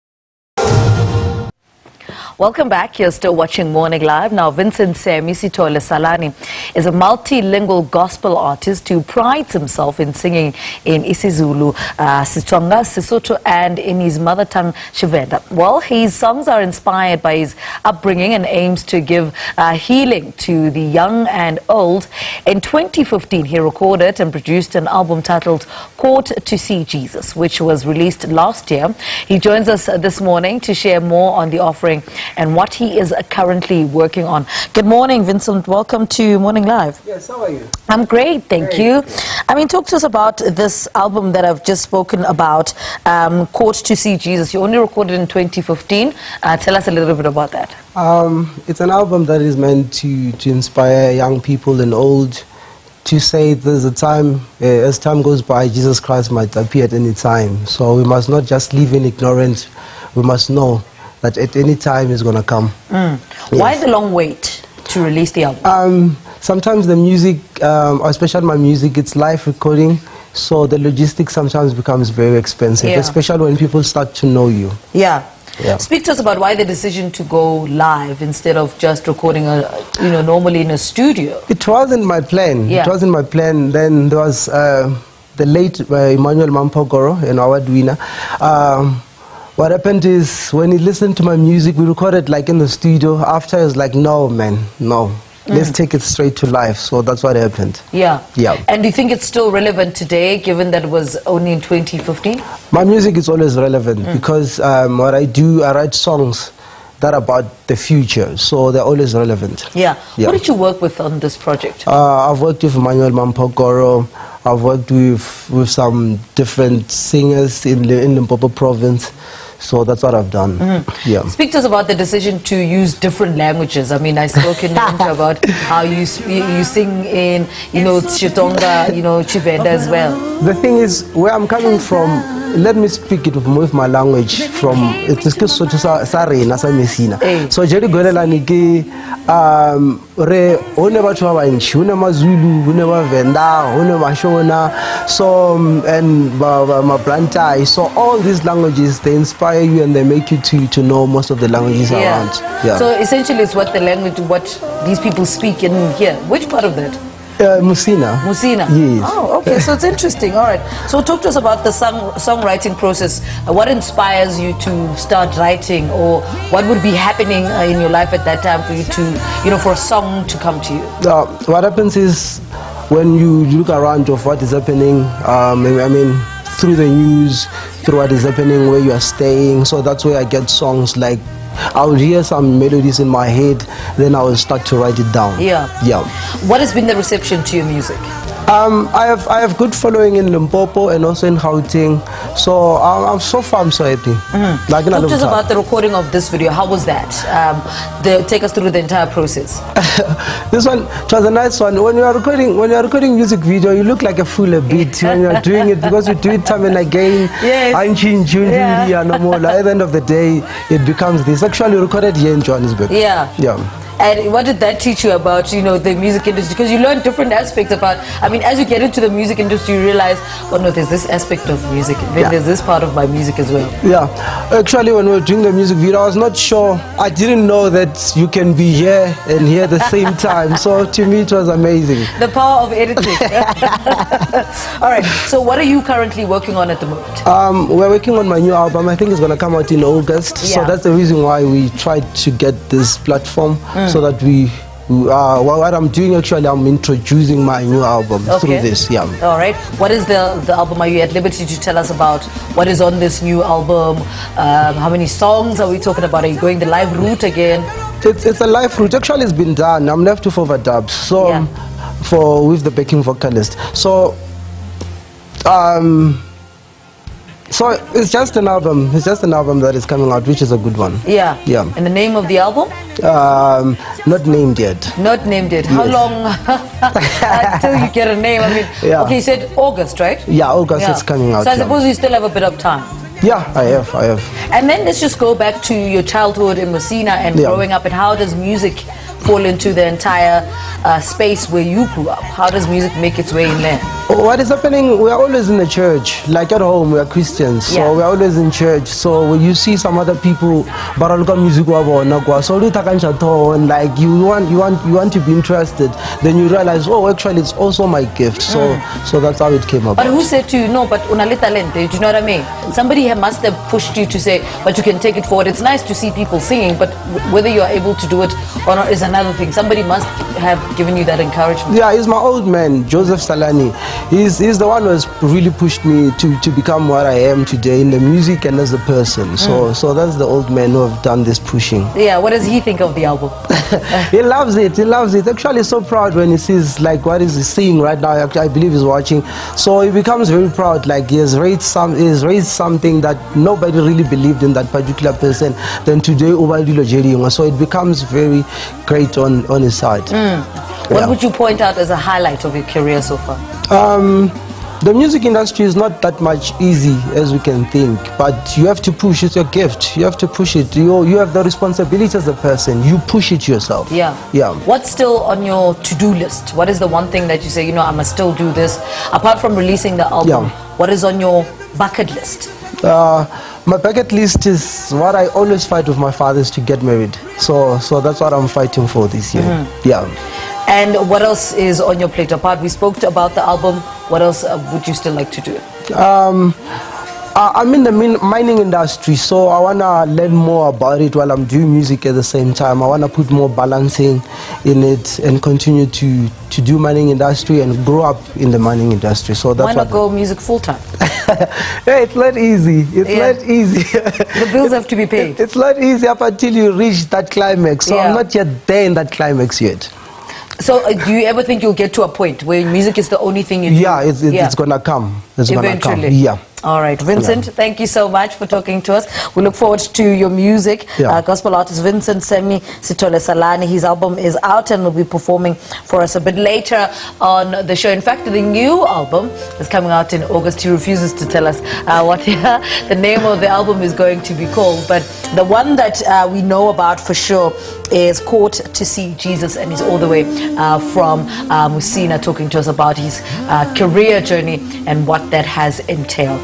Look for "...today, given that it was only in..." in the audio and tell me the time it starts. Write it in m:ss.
1:39.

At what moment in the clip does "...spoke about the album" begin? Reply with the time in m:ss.
6:22.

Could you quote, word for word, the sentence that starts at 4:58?
So when you see some other people, baraluka music so and like you want you want you want to be interested.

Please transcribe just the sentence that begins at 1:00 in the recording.
We must know that at any time it's going to come.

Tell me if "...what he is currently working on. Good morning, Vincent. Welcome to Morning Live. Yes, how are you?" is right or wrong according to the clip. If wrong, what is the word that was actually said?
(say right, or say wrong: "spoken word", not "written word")
right.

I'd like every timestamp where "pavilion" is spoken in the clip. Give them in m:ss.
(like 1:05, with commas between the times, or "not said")
not said.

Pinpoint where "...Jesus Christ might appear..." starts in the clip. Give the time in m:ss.
0:55.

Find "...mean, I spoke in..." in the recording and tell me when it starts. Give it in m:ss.
2:03.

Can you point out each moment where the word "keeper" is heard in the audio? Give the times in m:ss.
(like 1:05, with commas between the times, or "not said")
not said.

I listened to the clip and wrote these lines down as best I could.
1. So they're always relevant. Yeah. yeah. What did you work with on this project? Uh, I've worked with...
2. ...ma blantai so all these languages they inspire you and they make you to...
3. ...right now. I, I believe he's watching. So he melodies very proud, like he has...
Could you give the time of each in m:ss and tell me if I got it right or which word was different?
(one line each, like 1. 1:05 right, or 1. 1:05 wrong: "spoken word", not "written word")
1. 1:48 right
2. 2:26 right
3. 5:37 wrong: "becomes", not "melodies".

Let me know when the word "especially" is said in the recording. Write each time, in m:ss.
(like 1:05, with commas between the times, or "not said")
1:08, 1:12.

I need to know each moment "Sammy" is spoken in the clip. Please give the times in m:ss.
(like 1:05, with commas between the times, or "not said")
0:04, 7:02.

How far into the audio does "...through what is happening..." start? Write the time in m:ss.
2:57.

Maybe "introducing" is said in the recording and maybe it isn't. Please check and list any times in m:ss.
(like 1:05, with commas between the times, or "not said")
4:06.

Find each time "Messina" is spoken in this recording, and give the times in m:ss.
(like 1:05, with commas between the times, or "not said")
4:46.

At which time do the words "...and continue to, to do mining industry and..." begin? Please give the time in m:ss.
6:35.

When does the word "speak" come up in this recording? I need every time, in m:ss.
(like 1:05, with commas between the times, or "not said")
1:15, 2:01, 2:12, 2:35.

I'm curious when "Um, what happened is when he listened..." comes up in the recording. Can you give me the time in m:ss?
1:28.